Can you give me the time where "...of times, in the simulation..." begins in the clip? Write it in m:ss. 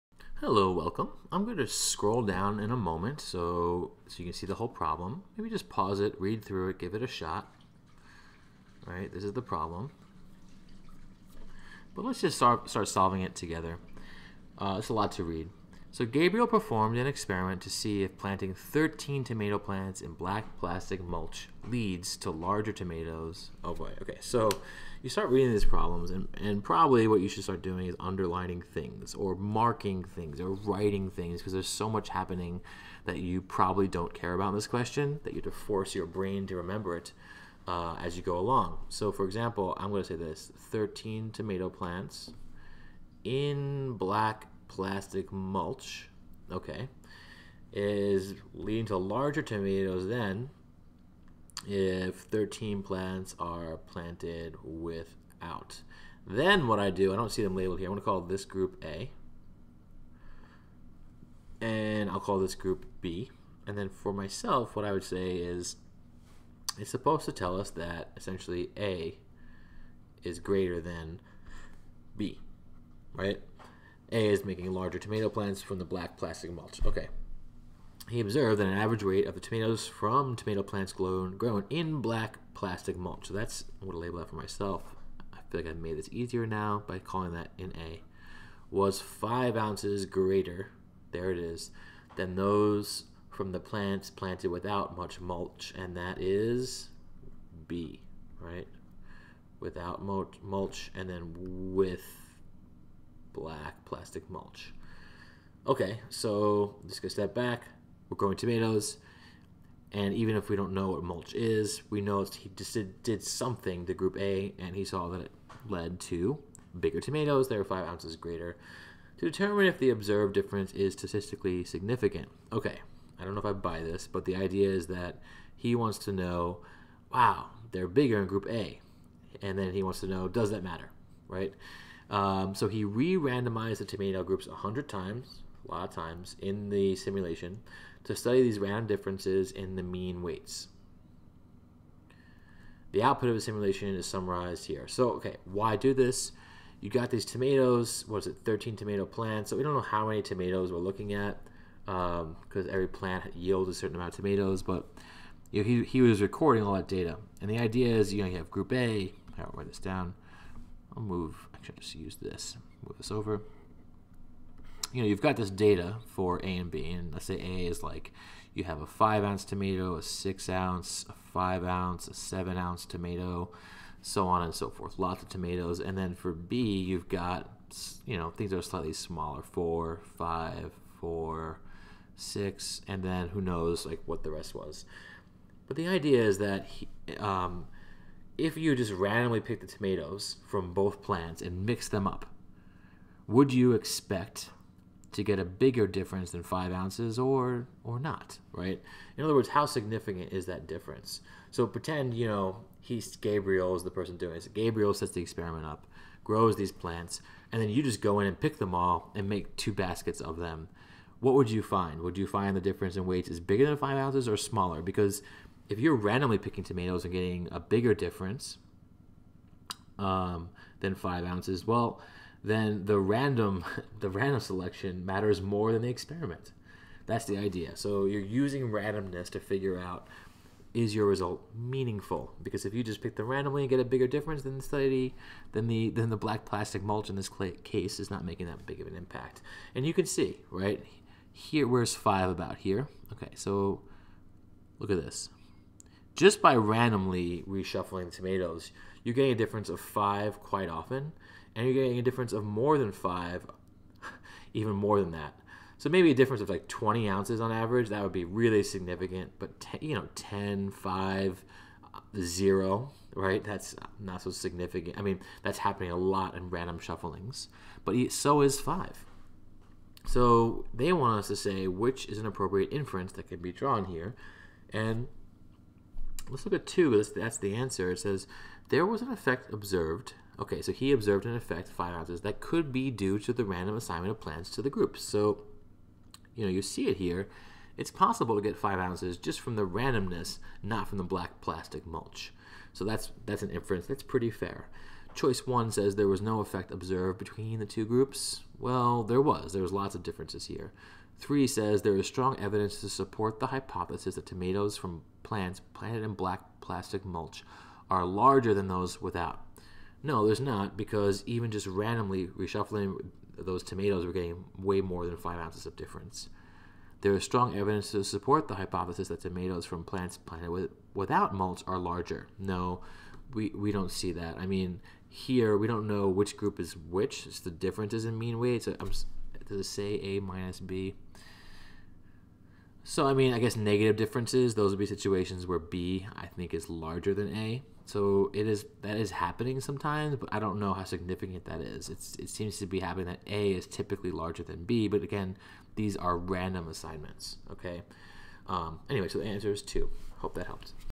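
2:15.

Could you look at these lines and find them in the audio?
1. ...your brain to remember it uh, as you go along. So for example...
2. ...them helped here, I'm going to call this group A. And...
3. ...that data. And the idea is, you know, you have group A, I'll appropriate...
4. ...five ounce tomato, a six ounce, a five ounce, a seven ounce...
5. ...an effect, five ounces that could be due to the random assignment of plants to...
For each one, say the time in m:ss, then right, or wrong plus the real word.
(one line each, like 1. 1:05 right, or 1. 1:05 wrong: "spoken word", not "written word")
1. 0:35 right
2. 0:57 wrong: "labeled", not "helped"
3. 2:36 wrong: "write", not "appropriate"
4. 2:48 right
5. 4:41 right.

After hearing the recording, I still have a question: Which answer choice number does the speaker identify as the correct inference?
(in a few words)
2.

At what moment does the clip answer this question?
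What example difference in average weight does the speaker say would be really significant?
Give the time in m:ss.
4:16.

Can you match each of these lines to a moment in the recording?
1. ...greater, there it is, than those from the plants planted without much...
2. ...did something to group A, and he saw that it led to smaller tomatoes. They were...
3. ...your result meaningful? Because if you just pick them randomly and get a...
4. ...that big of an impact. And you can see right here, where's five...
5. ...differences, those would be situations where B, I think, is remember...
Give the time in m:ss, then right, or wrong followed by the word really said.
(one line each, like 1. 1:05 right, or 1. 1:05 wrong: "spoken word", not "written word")
1. 1:30 right
2. 1:53 wrong: "bigger", not "smaller"
3. 3:50 right
4. 3:58 right
5. 5:33 wrong: "larger", not "remember".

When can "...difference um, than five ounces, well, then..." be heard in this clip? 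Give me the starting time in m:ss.
3:37.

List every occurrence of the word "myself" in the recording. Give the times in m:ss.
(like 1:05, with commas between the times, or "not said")
1:04, 1:24.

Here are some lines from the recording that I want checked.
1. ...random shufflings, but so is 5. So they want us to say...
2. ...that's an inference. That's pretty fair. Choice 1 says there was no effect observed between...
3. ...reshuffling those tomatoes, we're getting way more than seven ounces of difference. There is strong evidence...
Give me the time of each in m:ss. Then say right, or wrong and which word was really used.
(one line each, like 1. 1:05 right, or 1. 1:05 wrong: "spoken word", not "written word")
1. 4:26 right
2. 4:53 right
3. 5:12 wrong: "five", not "seven".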